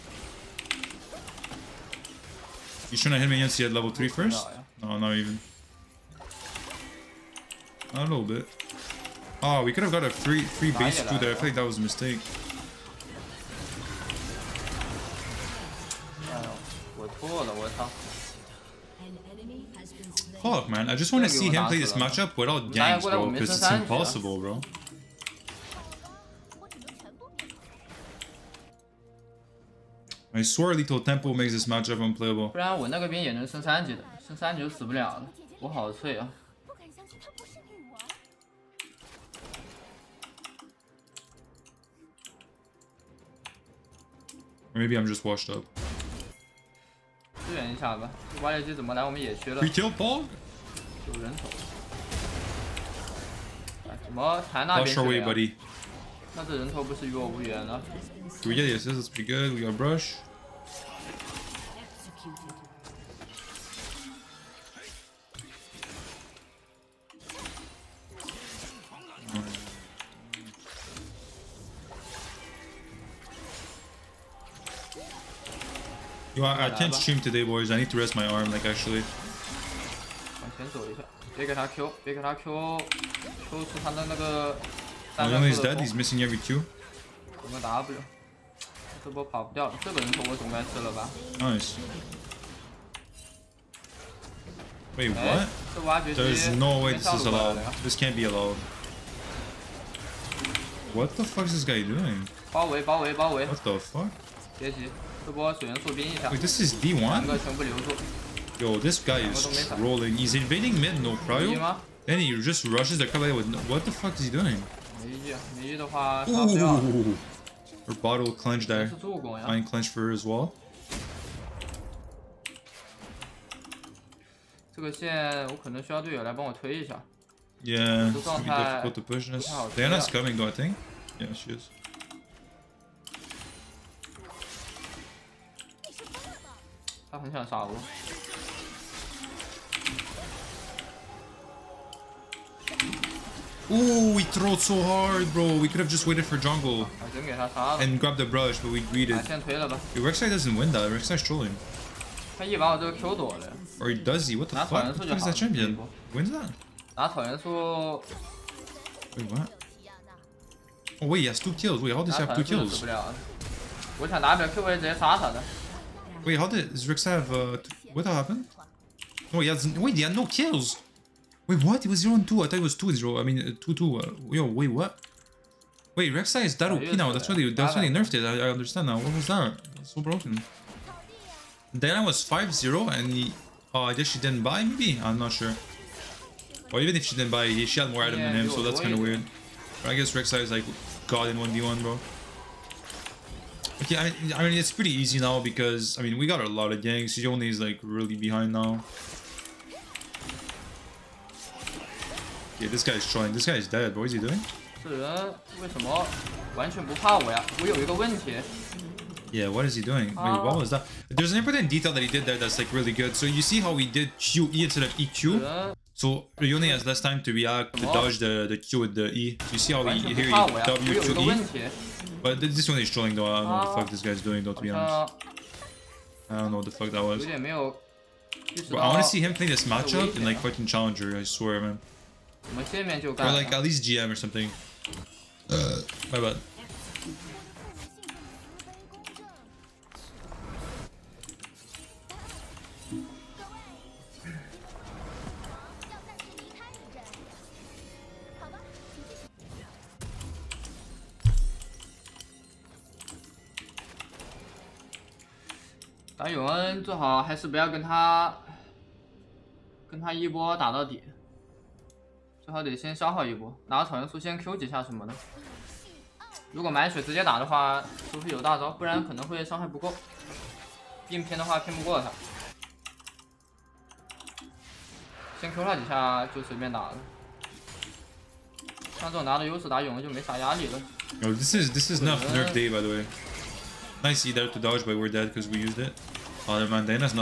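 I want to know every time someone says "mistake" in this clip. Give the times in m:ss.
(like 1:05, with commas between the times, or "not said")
0:11.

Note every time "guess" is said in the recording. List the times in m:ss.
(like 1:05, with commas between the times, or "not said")
3:03, 3:09.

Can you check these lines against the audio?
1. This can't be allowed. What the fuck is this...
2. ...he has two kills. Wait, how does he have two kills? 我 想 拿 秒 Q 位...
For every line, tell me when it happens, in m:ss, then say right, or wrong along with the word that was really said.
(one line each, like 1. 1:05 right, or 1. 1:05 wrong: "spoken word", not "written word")
1. 1:37 right
2. 2:41 right.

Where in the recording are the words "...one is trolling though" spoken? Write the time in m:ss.
3:42.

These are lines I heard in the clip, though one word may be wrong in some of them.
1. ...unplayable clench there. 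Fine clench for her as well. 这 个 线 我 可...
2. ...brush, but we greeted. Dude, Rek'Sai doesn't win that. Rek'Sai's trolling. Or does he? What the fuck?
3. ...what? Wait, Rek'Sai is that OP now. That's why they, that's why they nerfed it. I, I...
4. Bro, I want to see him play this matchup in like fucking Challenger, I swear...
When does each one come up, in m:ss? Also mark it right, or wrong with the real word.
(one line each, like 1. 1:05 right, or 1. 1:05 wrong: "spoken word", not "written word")
1. 1:58 wrong: "bottle", not "unplayable"
2. 2:28 right
3. 2:54 right
4. 3:47 right.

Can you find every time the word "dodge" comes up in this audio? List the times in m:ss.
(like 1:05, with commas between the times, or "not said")
3:37, 4:44.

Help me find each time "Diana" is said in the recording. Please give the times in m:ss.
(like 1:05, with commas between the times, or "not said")
2:09.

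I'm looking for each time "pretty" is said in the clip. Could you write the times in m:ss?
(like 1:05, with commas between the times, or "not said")
0:59, 3:14.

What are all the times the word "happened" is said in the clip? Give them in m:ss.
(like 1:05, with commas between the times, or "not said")
2:48.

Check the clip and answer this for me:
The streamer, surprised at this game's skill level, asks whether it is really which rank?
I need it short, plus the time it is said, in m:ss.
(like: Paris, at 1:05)
D1, at 1:46.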